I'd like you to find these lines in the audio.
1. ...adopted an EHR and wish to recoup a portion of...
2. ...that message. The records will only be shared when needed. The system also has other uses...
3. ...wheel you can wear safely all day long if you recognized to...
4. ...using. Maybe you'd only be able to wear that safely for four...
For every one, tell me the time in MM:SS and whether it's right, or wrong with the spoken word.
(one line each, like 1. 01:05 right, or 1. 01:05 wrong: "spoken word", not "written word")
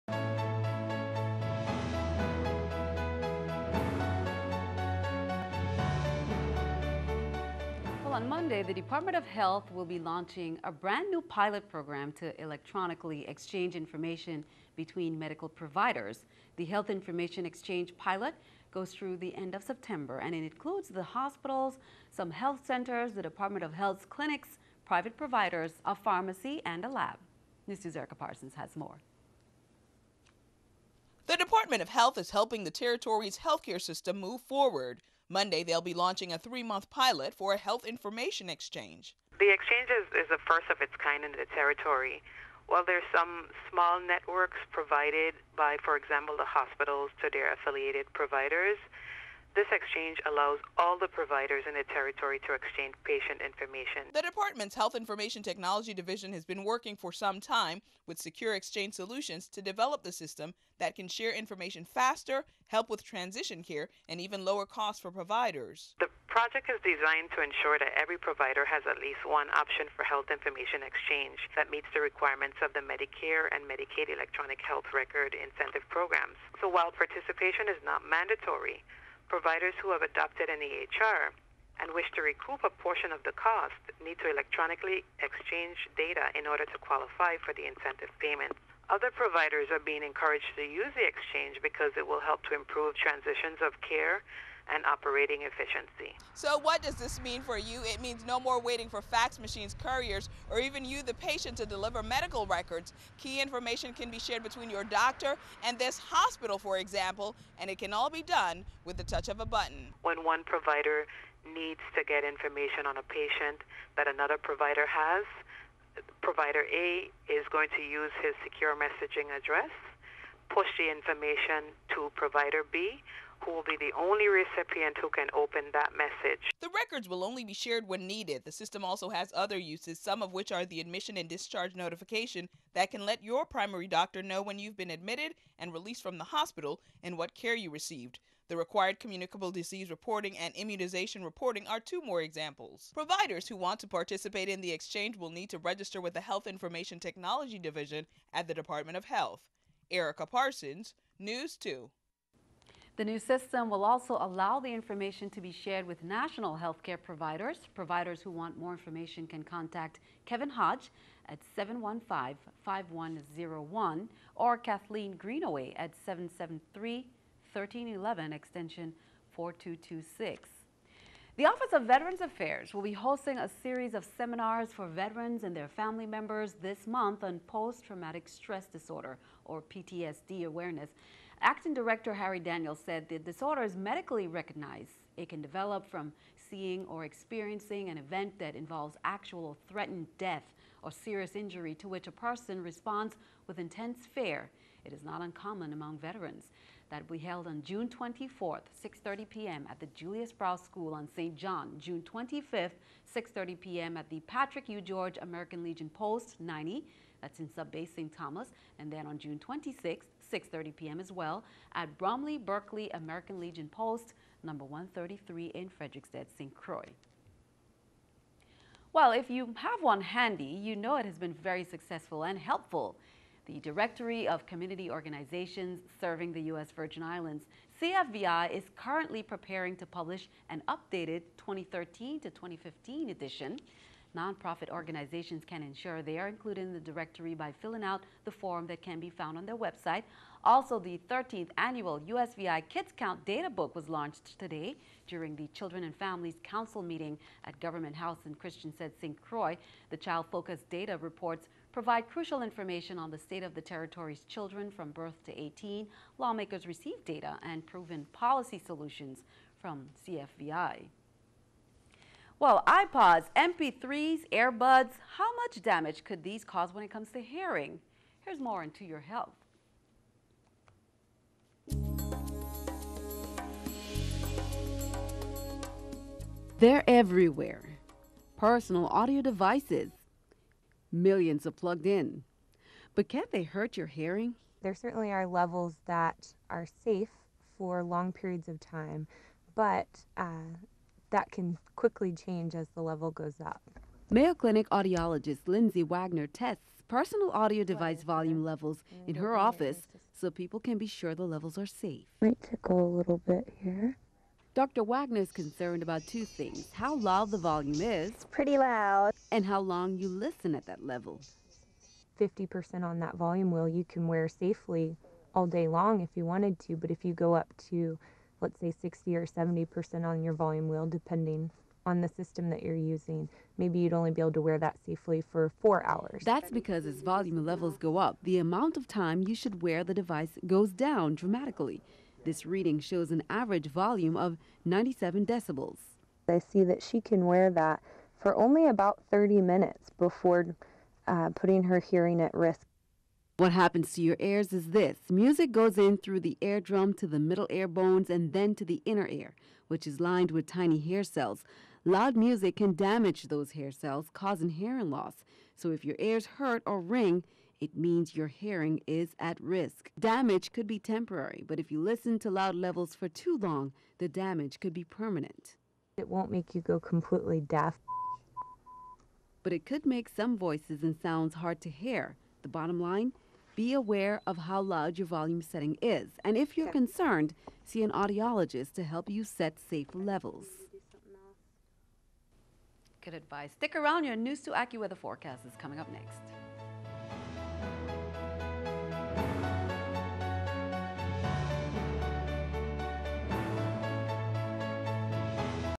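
1. 01:20 right
2. 02:05 right
3. 05:13 wrong: "wanted", not "recognized"
4. 05:22 right.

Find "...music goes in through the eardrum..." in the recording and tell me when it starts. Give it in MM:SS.
05:45.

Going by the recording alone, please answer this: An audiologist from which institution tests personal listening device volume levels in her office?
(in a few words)
Mayo Clinic.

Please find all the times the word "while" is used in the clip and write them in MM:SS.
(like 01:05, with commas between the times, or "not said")
00:42, 01:16.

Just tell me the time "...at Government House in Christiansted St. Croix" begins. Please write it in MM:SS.
04:07.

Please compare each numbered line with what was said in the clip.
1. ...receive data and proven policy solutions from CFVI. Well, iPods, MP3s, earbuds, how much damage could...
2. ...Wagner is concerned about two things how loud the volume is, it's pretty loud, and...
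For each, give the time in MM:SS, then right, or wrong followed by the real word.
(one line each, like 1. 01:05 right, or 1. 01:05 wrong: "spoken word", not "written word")
1. 04:16 right
2. 05:04 right.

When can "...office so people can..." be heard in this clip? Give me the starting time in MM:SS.
04:59.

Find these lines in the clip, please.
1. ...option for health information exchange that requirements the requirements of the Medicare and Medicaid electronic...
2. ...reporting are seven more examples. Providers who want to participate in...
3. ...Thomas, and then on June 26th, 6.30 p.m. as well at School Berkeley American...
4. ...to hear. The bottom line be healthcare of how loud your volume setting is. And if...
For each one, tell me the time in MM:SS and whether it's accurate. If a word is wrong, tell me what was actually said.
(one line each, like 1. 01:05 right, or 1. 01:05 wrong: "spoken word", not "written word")
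1. 01:09 wrong: "meets", not "requirements"
2. 02:21 wrong: "two", not "seven"
3. 03:28 wrong: "Bromley", not "School"
4. 06:11 wrong: "aware", not "healthcare".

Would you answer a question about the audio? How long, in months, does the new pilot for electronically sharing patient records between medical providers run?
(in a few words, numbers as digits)
3 months.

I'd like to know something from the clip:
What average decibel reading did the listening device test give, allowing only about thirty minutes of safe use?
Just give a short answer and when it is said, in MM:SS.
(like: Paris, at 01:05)
97 decibels, at 05:34.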